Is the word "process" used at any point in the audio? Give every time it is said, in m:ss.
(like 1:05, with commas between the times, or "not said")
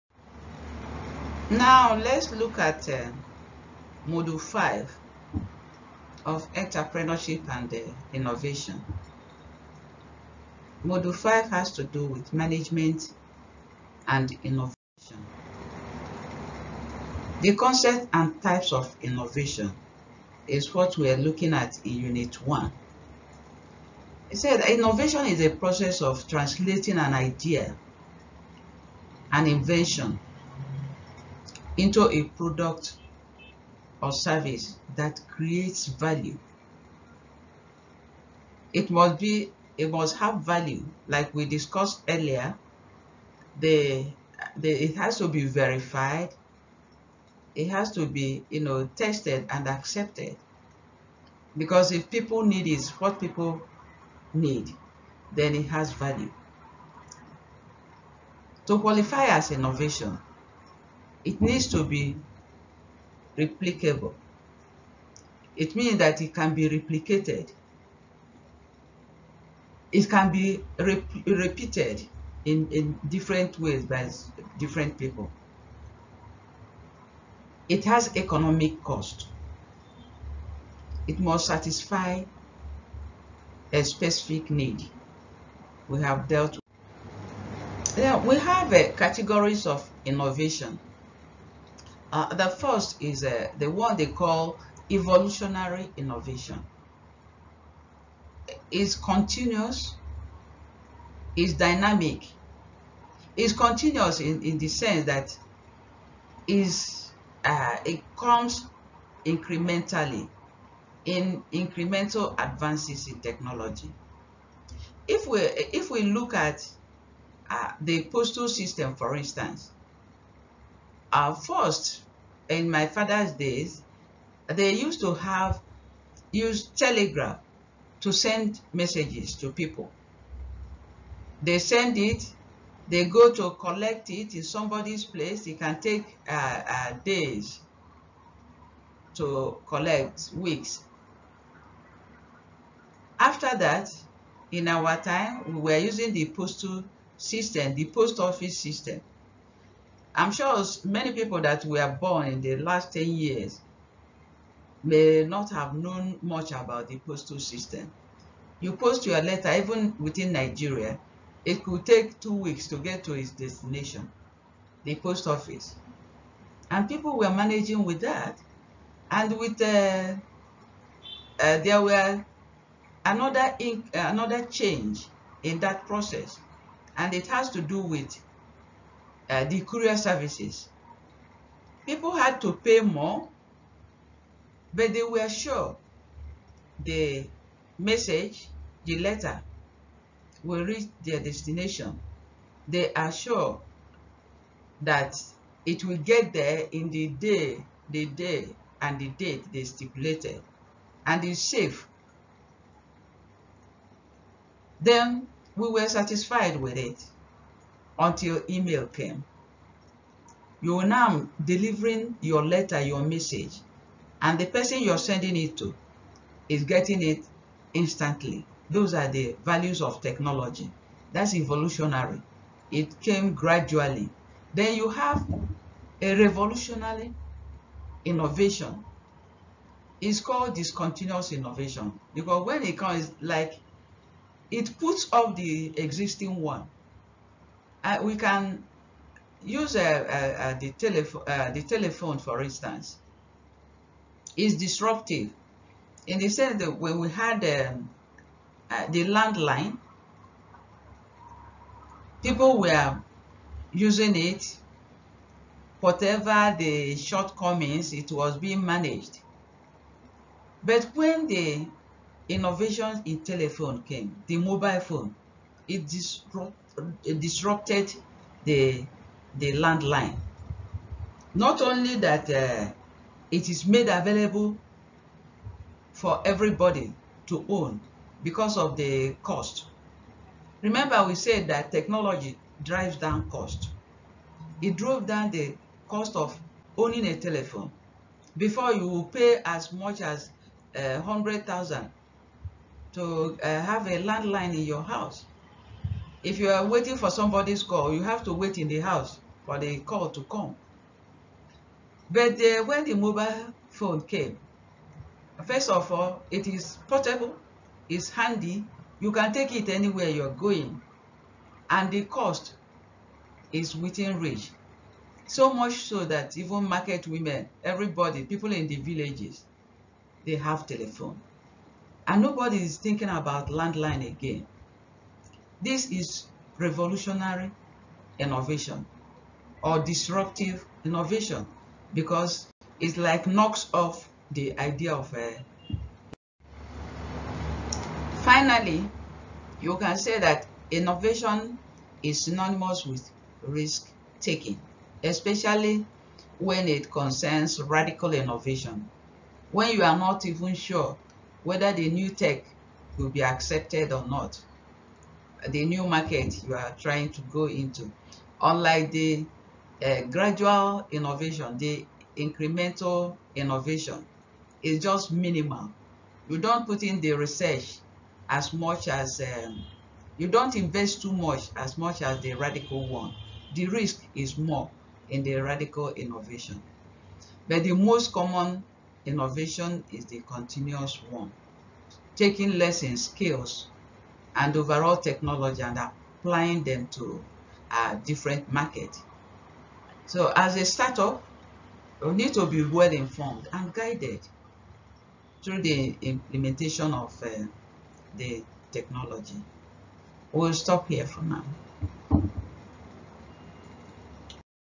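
0:25, 2:55.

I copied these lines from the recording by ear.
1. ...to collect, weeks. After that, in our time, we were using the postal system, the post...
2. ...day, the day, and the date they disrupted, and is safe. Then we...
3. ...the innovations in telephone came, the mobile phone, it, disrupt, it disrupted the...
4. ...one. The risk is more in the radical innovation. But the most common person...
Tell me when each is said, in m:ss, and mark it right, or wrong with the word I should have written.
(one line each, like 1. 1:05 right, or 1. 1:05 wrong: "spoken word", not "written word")
1. 2:19 right
2. 3:17 wrong: "stipulated", not "disrupted"
3. 4:21 right
4. 6:12 wrong: "innovation", not "person".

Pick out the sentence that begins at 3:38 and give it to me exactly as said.
Those are the values of technology.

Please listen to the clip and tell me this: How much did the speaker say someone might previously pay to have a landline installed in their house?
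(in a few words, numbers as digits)
100,000.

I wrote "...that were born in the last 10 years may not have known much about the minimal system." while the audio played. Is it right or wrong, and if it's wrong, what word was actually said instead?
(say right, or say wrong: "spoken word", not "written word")
wrong: "postal", not "minimal".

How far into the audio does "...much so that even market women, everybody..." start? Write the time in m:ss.
5:15.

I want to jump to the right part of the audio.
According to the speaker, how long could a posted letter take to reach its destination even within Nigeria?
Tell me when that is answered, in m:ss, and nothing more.
2:42.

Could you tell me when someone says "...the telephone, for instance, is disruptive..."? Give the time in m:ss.
4:01.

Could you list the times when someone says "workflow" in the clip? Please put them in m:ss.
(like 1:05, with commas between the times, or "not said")
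not said.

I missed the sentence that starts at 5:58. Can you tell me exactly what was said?
Unlike the uh, gradual innovation, the incremental innovation is just minimal.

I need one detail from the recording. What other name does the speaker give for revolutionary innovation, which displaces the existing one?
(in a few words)
Discontinuous innovation.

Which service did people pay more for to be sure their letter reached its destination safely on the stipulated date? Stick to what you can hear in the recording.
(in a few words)
Courier services.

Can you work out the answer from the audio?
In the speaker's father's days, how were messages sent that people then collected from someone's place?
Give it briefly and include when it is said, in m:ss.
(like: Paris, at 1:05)
Telegraph, at 2:06.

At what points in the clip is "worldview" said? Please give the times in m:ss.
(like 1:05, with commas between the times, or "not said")
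not said.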